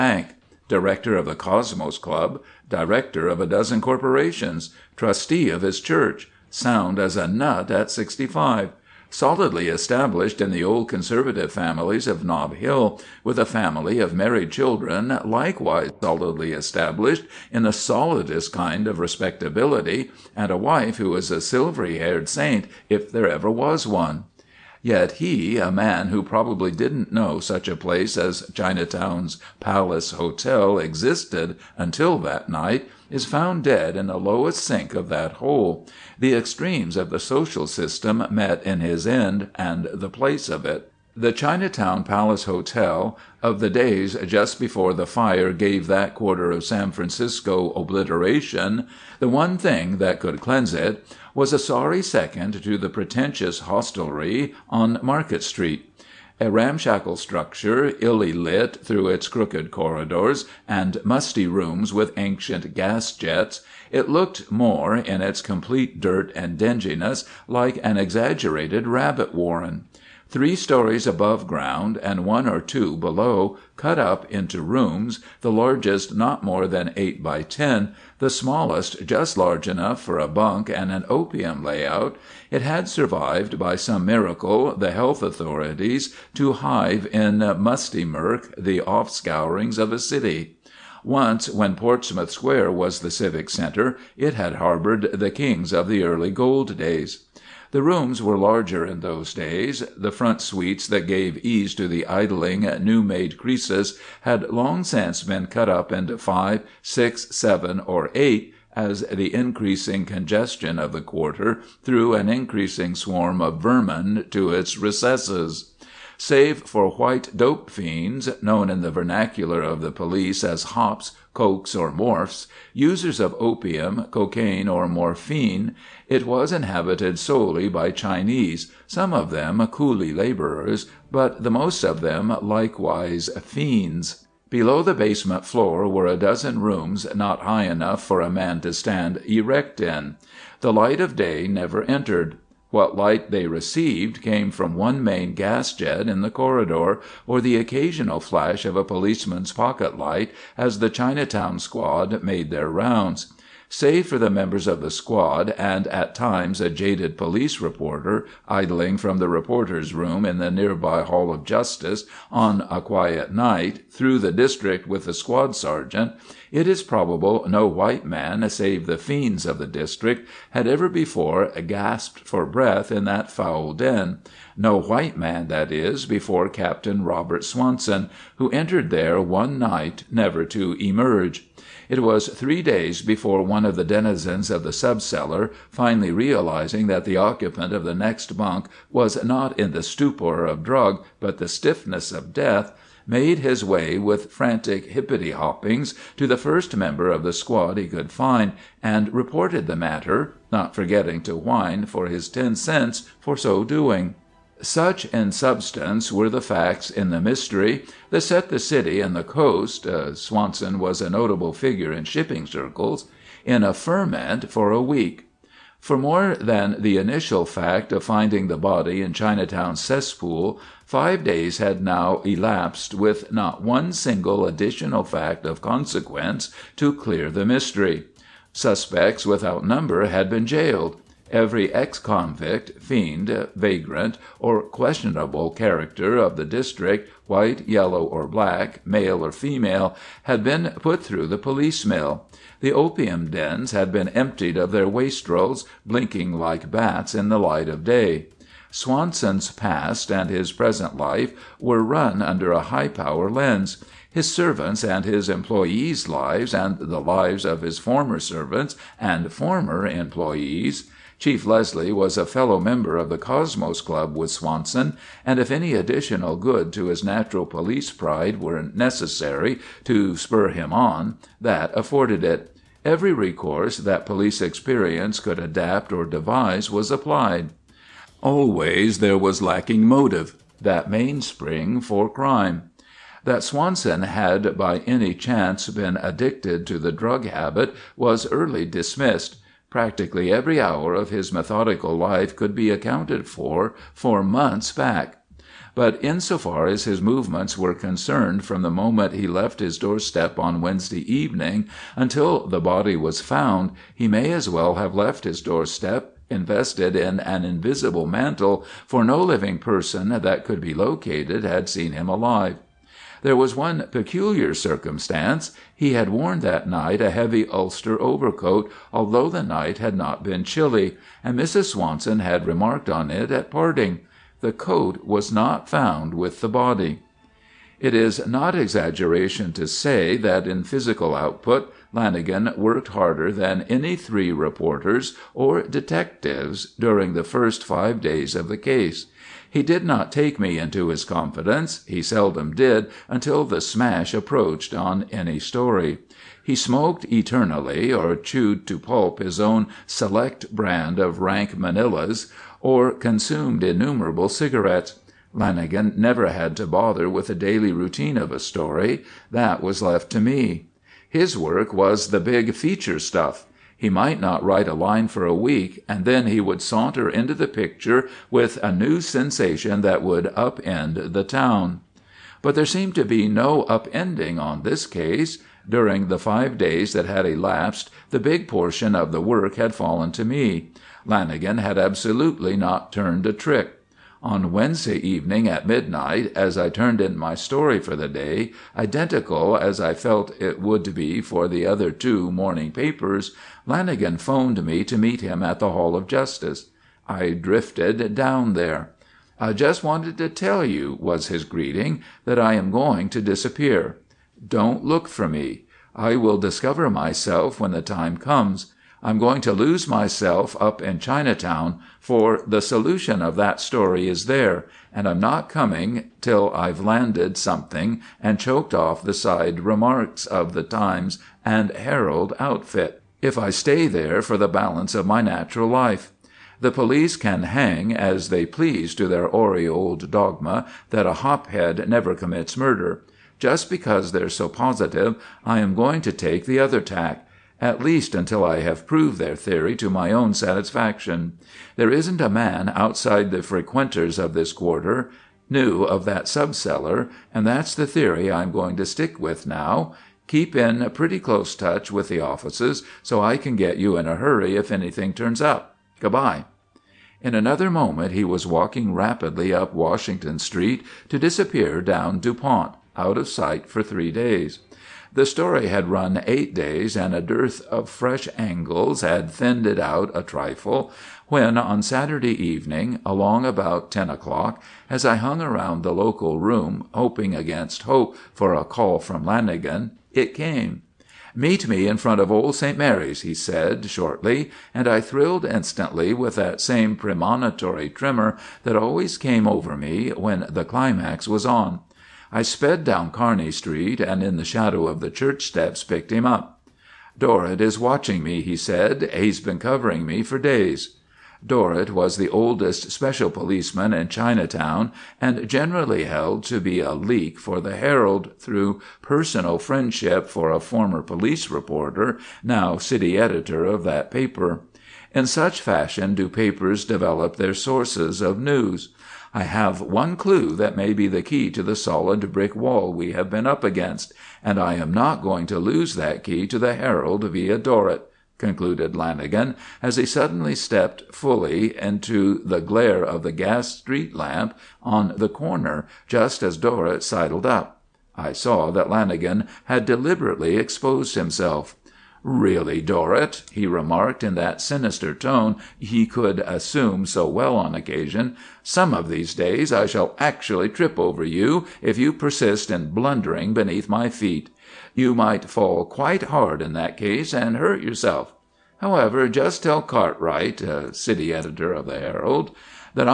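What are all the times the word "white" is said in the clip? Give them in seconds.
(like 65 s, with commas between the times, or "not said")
116 s, 167 s, 174 s, 237 s.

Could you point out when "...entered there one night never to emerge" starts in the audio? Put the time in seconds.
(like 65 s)
178 s.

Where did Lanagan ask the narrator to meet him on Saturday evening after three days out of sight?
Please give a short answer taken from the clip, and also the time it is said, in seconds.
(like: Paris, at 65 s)
old St. Mary's, at 482 s.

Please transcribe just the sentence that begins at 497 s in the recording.
Dorrit is watching me," he said.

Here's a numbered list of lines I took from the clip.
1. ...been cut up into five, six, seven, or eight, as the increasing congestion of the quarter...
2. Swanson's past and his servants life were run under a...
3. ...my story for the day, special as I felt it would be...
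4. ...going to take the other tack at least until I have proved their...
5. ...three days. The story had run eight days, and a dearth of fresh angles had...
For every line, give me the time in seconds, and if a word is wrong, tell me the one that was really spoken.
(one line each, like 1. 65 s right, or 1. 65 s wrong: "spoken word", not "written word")
1. 105 s right
2. 248 s wrong: "present", not "servants"
3. 387 s wrong: "identical", not "special"
4. 435 s right
5. 463 s right.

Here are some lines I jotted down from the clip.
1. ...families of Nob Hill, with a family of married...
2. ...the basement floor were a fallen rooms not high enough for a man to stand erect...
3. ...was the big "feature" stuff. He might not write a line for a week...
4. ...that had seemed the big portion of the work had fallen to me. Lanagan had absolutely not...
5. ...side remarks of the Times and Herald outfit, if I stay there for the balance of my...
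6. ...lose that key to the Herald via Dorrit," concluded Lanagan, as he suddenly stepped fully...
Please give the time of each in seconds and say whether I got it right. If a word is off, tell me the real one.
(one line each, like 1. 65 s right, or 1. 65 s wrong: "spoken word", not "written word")
1. 11 s right
2. 134 s wrong: "dozen", not "fallen"
3. 361 s right
4. 376 s wrong: "elapsed", not "seemed"
5. 419 s right
6. 525 s right.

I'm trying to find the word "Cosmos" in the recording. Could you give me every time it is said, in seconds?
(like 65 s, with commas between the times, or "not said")
1 s, 263 s.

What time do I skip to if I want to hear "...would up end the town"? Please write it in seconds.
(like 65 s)
370 s.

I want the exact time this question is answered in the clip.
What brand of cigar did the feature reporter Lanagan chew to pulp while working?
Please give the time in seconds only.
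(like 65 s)
351 s.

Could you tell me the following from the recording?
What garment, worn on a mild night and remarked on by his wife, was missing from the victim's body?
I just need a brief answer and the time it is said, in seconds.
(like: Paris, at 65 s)
heavy ulster overcoat, at 317 s.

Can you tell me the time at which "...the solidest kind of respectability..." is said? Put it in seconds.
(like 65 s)
17 s.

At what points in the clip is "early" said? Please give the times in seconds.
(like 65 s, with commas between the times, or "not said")
96 s, 288 s.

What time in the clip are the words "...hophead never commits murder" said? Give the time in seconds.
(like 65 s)
431 s.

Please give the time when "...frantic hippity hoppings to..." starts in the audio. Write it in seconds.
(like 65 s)
194 s.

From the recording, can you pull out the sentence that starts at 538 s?
I saw that Lanagan had deliberately exposed himself.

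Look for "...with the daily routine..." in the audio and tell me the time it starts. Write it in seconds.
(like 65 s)
357 s.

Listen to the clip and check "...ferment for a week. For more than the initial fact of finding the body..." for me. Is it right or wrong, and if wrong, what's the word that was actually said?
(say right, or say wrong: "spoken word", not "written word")
right.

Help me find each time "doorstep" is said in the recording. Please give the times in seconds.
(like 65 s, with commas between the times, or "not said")
299 s, 305 s.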